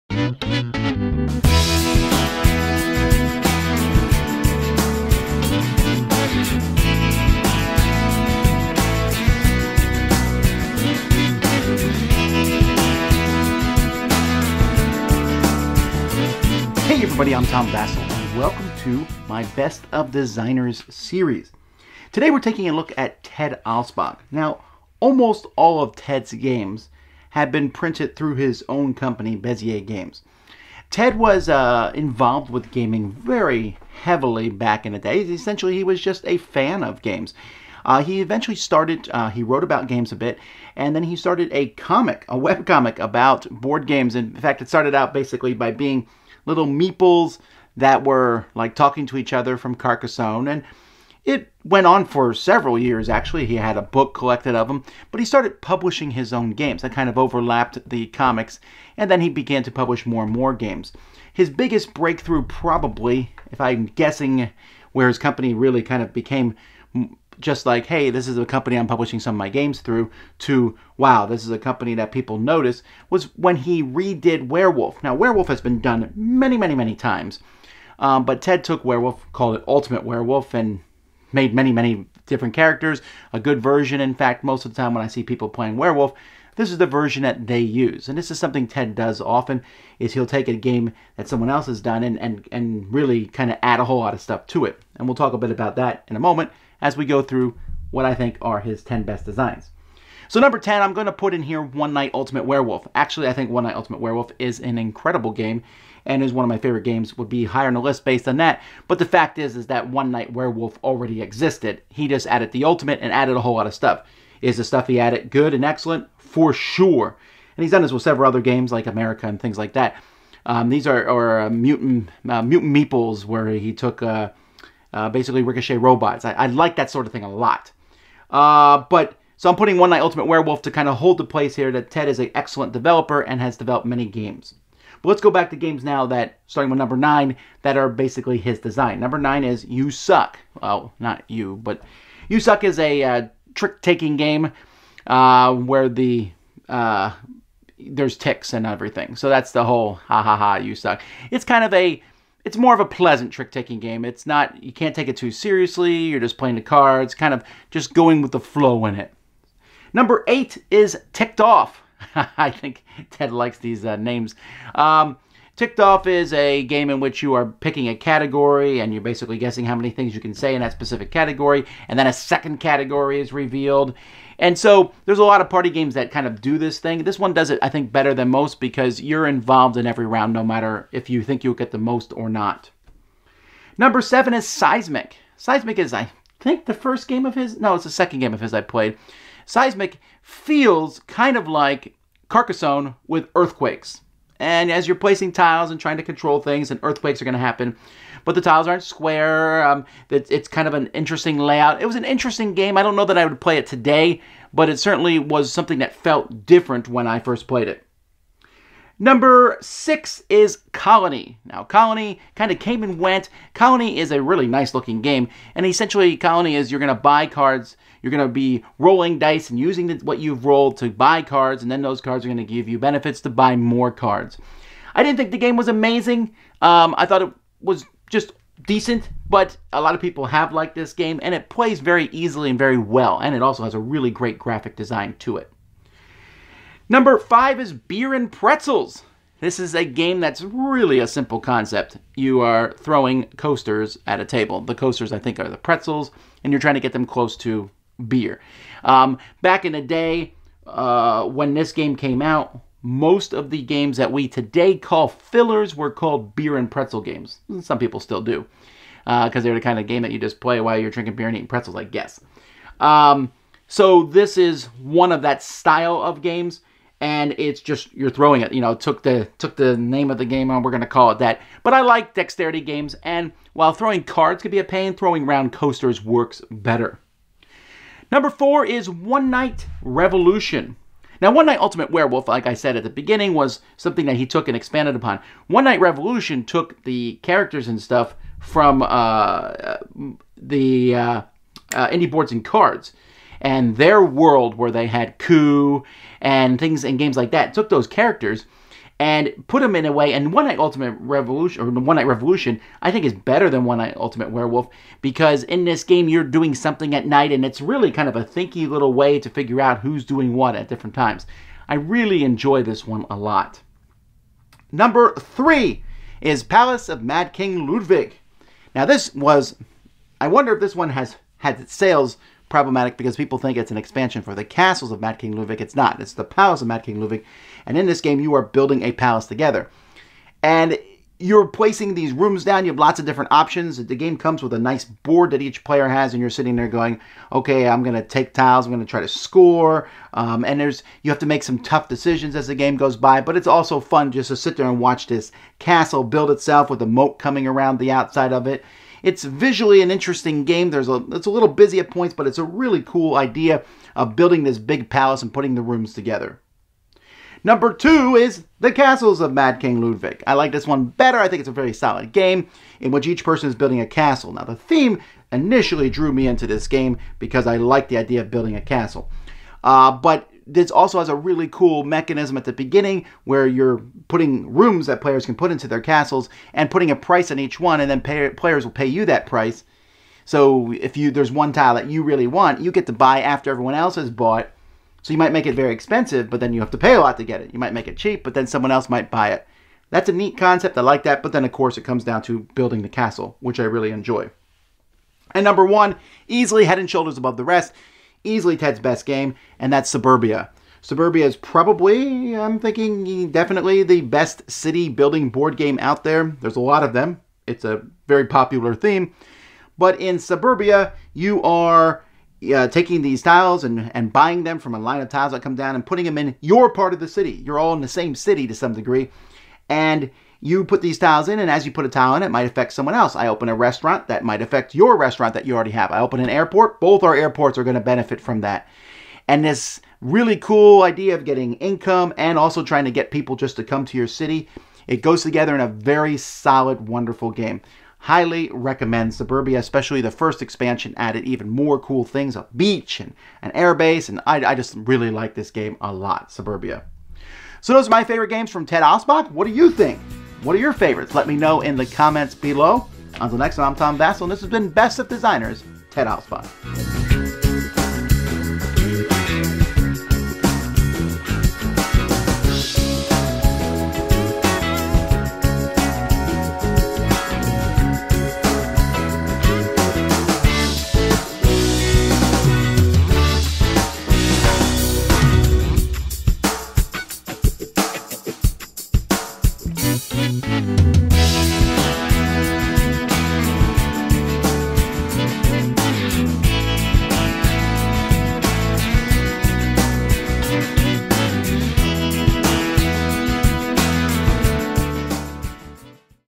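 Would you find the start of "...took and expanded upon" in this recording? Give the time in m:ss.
4:44.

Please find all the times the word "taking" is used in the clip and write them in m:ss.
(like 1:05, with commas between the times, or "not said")
0:22, 2:23, 2:33, 6:52.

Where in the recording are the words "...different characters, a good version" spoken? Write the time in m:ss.
1:22.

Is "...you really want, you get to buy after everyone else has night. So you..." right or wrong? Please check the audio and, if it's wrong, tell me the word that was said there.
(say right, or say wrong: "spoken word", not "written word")
wrong: "bought", not "night".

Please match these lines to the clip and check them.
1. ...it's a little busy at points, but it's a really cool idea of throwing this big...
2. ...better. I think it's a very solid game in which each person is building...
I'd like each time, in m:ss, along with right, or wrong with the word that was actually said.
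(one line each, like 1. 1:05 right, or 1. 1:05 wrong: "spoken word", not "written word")
1. 5:51 wrong: "building", not "throwing"
2. 6:00 right.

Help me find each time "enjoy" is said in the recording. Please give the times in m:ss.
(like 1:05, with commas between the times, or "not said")
5:12, 6:33.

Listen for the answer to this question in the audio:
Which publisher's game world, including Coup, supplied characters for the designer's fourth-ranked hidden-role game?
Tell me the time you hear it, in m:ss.
4:51.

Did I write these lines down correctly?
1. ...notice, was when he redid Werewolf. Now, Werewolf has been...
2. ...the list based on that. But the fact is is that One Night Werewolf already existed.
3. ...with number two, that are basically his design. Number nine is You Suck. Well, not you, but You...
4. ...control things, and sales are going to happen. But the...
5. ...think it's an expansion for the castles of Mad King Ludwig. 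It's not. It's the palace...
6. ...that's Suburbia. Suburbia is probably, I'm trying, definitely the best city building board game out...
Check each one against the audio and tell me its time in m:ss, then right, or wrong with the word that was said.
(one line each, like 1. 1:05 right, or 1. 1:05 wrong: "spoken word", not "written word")
1. 1:12 right
2. 1:47 right
3. 2:16 wrong: "nine", not "two"
4. 3:16 wrong: "earthquakes", not "sales"
5. 5:23 right
6. 6:39 wrong: "thinking", not "trying".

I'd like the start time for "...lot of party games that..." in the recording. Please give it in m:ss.
2:55.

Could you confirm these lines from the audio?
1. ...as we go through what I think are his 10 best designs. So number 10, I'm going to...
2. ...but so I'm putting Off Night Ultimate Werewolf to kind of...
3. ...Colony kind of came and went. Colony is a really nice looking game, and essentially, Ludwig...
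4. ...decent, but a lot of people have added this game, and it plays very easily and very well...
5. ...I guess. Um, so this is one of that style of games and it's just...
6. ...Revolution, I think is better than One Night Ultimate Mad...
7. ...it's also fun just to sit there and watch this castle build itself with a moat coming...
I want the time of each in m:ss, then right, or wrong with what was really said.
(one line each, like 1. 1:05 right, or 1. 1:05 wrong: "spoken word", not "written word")
1. 1:36 right
2. 2:08 wrong: "One", not "Off"
3. 3:31 wrong: "Colony", not "Ludwig"
4. 3:48 wrong: "liked", not "added"
5. 4:21 right
6. 5:02 wrong: "Werewolf", not "Mad"
7. 5:43 right.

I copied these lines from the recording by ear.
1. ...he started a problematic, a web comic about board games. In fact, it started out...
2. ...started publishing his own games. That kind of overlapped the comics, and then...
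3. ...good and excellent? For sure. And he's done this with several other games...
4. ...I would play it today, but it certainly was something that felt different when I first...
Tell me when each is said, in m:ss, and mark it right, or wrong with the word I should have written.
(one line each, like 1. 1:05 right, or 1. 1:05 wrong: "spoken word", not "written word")
1. 0:41 wrong: "comic", not "problematic"
2. 0:55 right
3. 1:55 right
4. 3:23 right.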